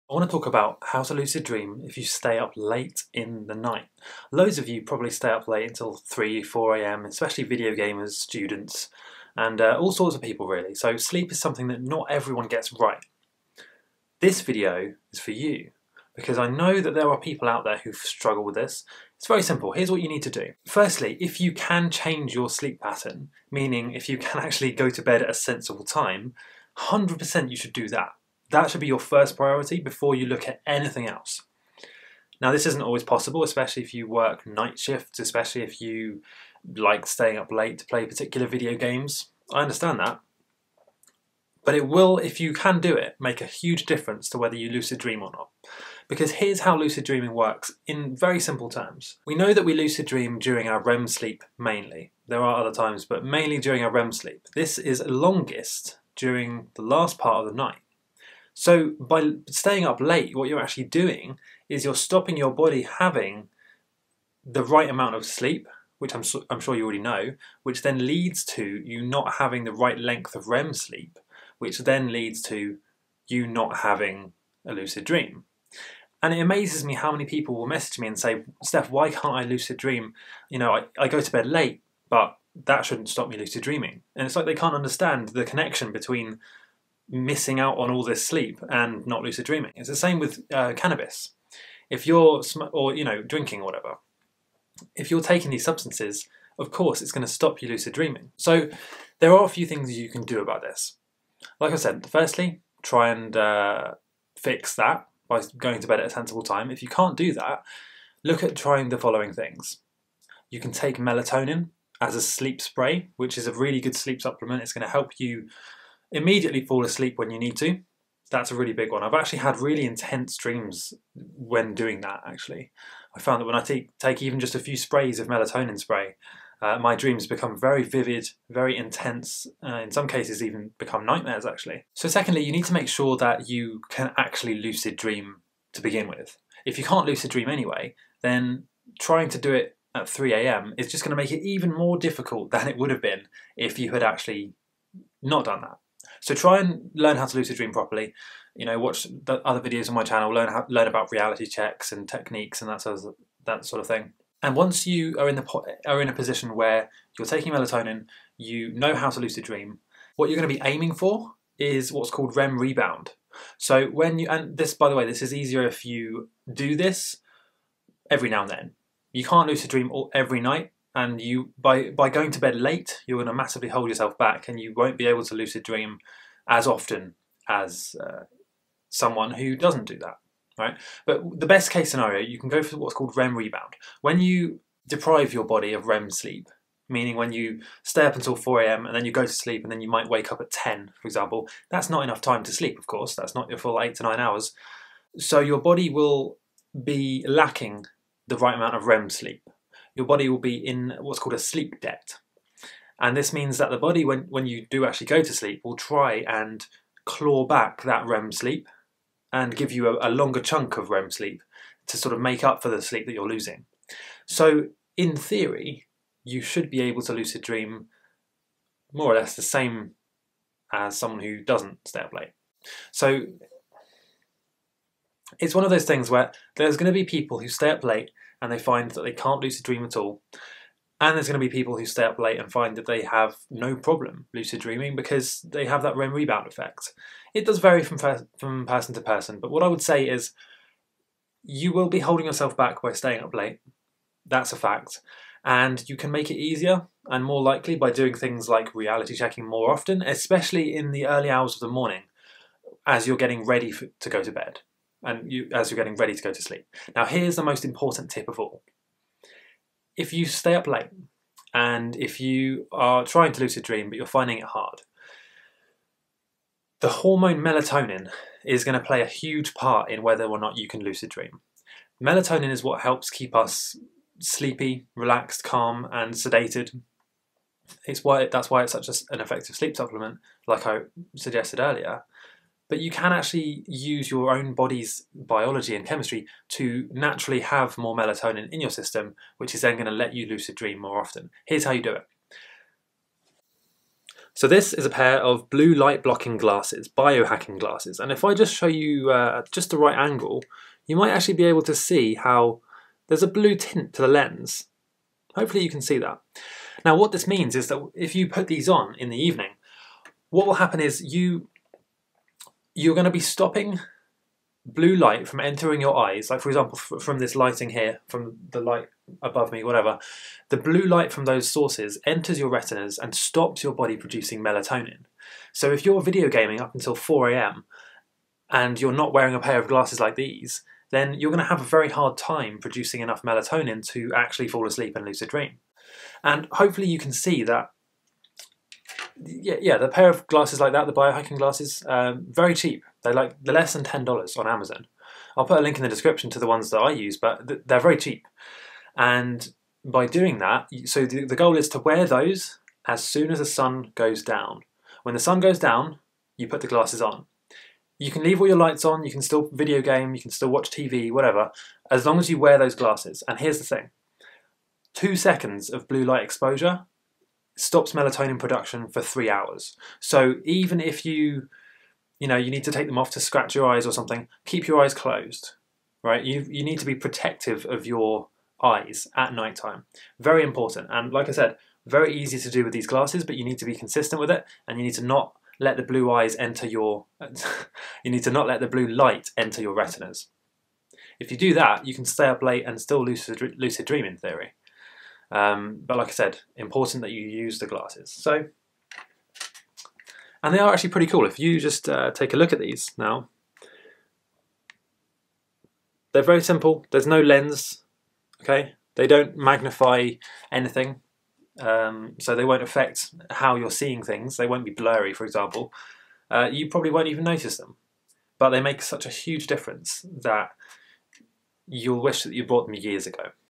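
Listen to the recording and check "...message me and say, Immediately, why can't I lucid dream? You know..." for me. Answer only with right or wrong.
wrong.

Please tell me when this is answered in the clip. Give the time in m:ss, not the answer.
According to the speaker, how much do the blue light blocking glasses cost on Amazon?
5:43.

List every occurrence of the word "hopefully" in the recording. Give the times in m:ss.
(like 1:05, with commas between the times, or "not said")
5:05, 5:36.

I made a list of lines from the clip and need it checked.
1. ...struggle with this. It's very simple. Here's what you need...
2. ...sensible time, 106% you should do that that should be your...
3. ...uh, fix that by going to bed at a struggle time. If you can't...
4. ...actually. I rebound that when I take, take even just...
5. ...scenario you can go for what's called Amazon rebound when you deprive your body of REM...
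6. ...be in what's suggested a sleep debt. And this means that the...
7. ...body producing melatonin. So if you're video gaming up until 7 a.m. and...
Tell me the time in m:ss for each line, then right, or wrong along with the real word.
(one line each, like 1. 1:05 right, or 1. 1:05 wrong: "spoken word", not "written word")
1. 0:17 right
2. 0:25 wrong: "100", not "106"
3. 1:43 wrong: "sensible", not "struggle"
4. 2:02 wrong: "found", not "rebound"
5. 3:01 wrong: "REM", not "Amazon"
6. 3:20 wrong: "called", not "suggested"
7. 5:23 wrong: "4", not "7".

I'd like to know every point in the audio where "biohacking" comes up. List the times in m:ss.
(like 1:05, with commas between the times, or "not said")
4:56, 5:40.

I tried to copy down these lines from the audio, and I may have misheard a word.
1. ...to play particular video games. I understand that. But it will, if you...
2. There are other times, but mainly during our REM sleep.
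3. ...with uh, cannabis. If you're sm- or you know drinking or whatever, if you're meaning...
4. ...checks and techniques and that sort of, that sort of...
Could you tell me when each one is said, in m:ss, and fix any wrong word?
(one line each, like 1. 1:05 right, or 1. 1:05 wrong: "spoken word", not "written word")
1. 0:37 right
2. 0:52 right
3. 1:30 wrong: "taking", not "meaning"
4. 2:31 right.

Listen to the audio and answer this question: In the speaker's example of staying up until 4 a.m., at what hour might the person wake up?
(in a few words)
10.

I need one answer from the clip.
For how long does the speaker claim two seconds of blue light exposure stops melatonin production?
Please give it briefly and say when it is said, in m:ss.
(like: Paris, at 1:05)
3 hours, at 6:09.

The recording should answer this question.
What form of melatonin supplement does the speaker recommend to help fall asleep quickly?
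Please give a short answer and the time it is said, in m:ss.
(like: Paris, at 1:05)
Sleep spray, at 1:52.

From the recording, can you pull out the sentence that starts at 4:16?
Now, here's the most important tip of all.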